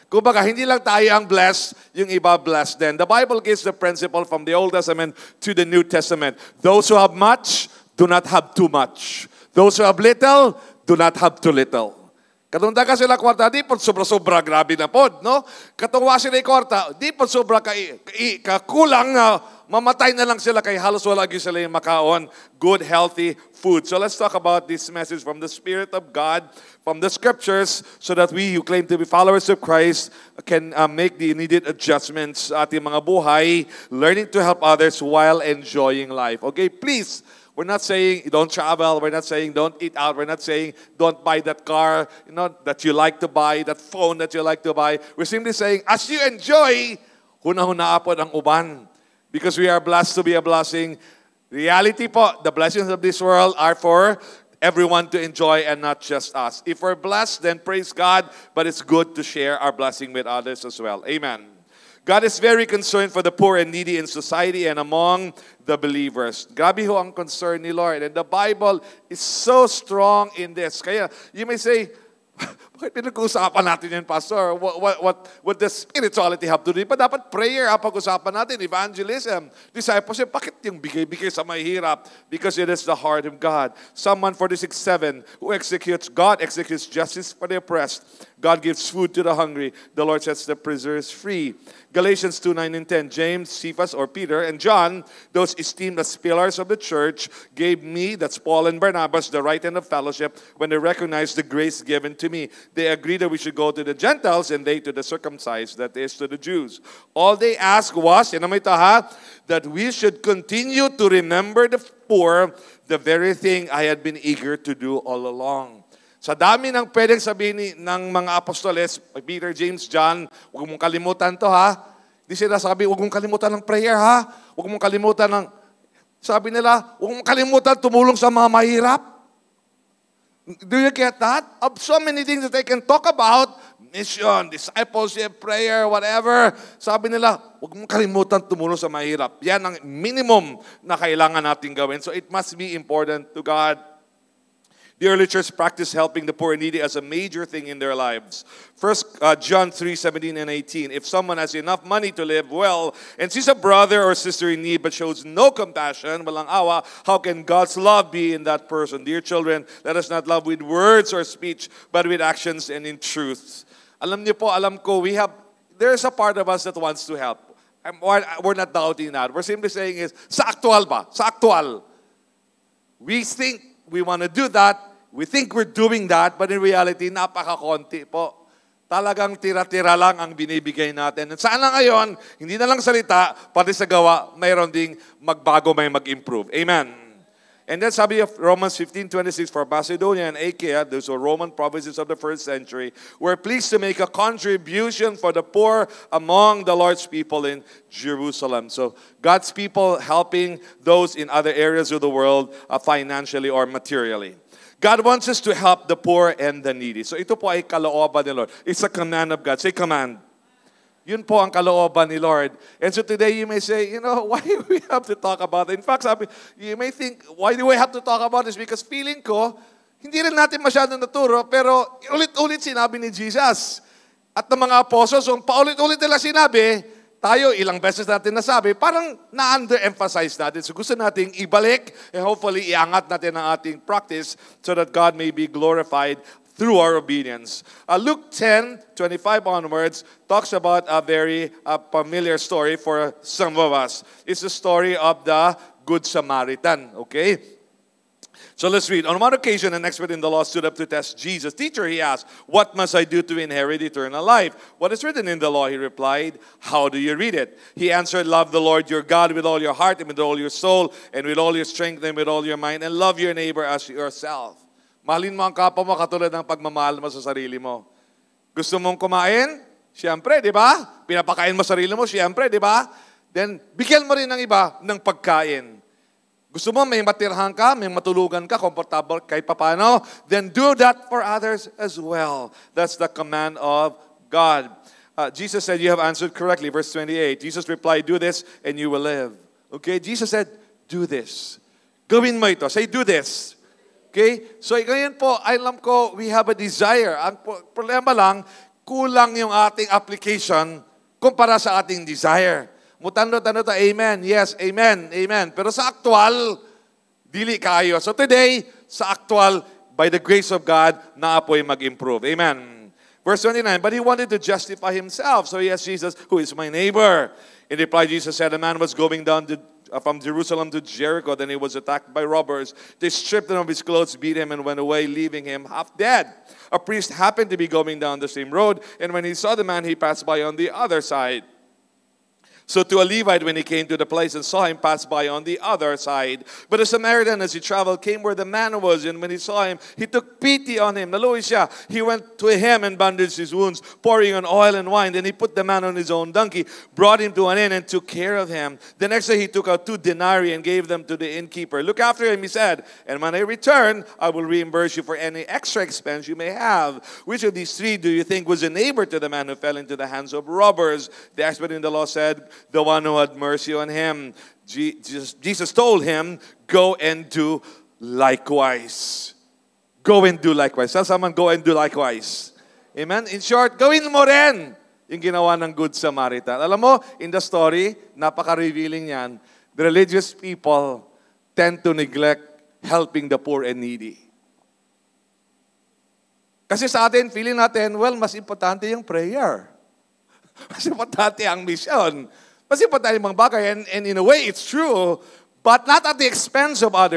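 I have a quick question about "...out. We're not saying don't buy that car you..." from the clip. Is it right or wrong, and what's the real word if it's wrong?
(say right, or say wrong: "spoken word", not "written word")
right.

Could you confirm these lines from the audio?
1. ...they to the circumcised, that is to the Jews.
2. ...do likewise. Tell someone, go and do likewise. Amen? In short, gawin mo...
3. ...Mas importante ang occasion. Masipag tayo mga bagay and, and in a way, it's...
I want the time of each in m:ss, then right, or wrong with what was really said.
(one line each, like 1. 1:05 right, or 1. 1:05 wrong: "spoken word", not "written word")
1. 1:44 right
2. 6:10 right
3. 6:30 wrong: "mission", not "occasion".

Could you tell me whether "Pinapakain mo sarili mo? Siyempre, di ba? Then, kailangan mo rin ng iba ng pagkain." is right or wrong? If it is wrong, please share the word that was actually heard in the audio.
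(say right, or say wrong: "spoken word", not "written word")
wrong: "bigyan", not "kailangan".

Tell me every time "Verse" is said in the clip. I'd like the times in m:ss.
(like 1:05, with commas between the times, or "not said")
4:46, 5:13.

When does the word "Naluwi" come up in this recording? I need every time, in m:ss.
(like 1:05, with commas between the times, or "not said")
5:41.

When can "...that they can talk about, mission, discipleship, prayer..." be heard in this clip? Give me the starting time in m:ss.
2:12.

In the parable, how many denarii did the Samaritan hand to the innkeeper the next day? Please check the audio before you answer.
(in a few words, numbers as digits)
2.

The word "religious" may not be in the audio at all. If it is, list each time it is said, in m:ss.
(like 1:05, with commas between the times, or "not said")
6:19.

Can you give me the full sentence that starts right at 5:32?
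So to a Levite, when he came to the place and saw him, pass by on the other side.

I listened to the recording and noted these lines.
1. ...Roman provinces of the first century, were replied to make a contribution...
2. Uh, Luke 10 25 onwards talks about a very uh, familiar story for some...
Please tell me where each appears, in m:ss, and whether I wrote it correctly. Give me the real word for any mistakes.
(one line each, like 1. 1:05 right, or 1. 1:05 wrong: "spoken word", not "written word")
1. 3:11 wrong: "pleased", not "replied"
2. 3:57 right.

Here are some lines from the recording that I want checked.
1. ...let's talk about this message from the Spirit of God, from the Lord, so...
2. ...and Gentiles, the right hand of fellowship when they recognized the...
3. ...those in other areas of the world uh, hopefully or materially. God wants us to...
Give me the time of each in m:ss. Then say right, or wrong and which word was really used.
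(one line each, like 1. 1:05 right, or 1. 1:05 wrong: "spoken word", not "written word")
1. 0:23 wrong: "Scriptures", not "Lord"
2. 1:38 wrong: "Barnabas", not "Gentiles"
3. 3:20 wrong: "financially", not "hopefully".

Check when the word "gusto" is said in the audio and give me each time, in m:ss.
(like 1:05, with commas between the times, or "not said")
3:50, 4:28, 4:36.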